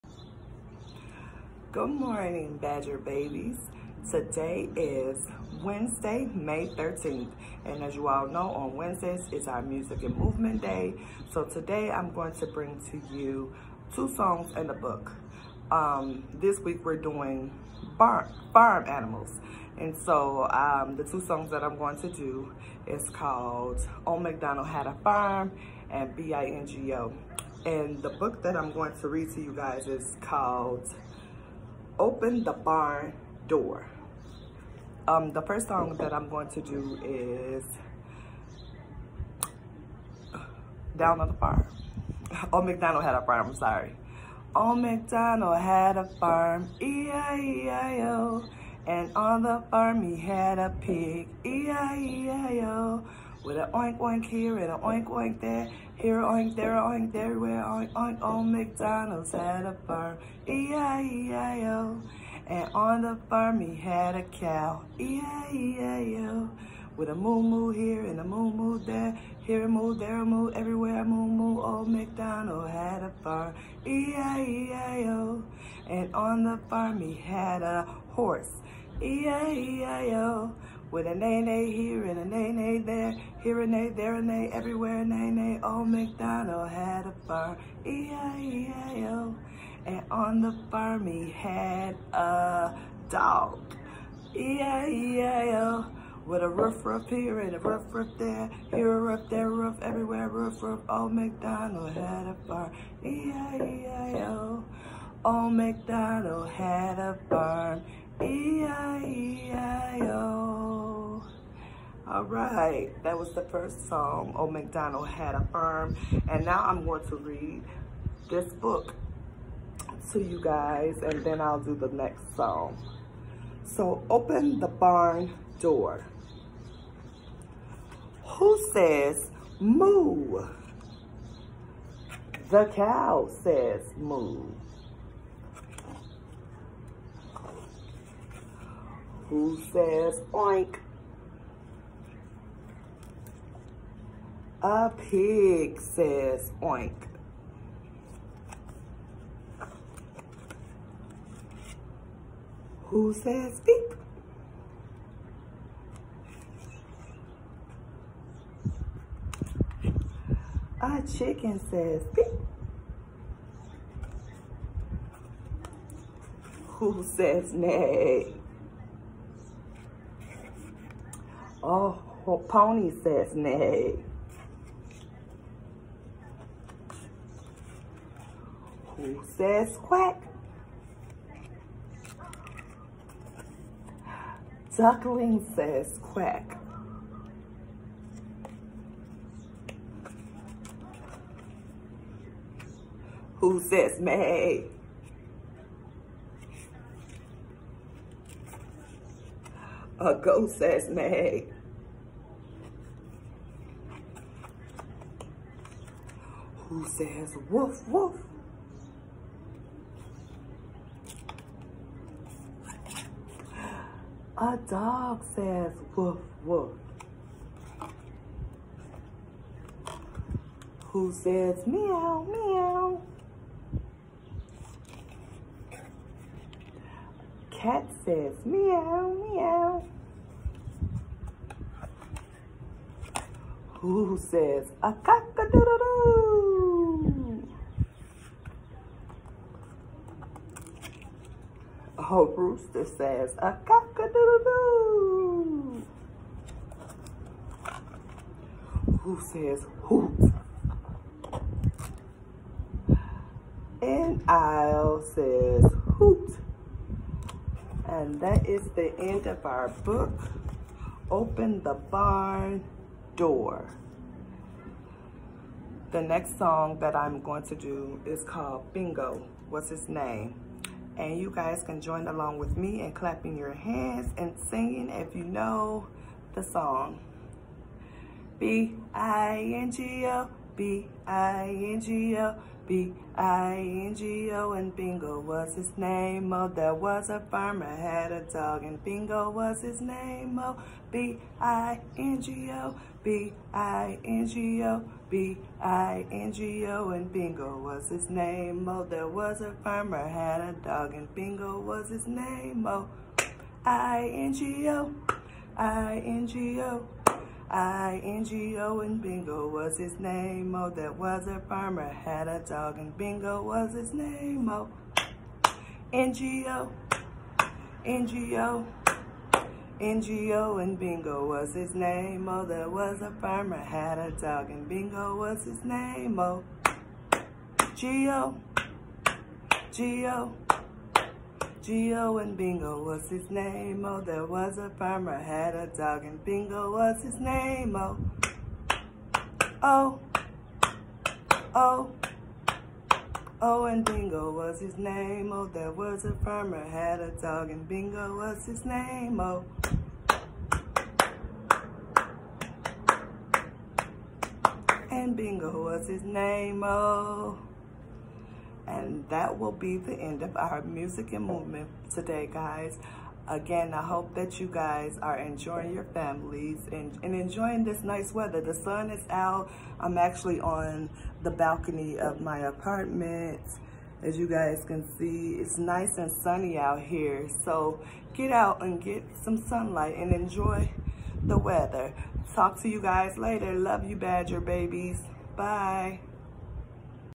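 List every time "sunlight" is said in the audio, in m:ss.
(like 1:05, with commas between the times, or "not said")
6:19.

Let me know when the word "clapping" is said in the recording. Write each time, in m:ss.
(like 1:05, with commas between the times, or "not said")
4:32.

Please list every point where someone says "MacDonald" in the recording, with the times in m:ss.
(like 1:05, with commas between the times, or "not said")
1:11, 1:25, 1:41, 1:45, 1:54.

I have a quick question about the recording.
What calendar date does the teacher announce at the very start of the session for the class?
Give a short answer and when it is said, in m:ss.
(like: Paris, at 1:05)
May 13th, at 0:06.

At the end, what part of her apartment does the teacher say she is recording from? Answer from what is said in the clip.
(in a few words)
Balcony.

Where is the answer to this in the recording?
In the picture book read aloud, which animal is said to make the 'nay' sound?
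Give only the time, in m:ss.
2:52.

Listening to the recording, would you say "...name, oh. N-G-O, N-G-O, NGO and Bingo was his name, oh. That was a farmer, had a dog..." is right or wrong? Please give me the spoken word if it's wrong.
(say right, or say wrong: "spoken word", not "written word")
right.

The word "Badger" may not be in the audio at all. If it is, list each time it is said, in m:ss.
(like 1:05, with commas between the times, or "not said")
0:02, 6:23.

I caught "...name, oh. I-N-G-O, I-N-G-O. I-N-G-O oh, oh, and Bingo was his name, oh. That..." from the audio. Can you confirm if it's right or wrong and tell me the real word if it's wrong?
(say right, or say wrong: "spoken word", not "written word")
right.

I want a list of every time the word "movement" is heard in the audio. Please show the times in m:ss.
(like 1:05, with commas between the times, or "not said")
0:10, 6:01.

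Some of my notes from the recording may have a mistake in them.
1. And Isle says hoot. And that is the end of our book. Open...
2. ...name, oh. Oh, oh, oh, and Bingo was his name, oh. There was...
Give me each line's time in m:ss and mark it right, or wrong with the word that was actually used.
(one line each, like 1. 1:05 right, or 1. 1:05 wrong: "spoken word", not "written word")
1. 4:13 right
2. 5:37 right.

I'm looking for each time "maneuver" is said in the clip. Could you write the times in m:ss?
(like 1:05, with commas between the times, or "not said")
not said.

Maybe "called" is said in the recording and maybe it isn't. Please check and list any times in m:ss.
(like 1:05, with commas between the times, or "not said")
0:23, 0:30, 4:28.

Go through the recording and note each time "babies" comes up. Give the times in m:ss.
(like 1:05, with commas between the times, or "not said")
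0:02, 6:24.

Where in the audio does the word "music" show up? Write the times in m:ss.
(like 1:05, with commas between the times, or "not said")
0:09, 6:00.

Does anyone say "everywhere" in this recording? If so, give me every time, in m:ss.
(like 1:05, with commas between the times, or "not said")
1:10, 1:24, 1:39.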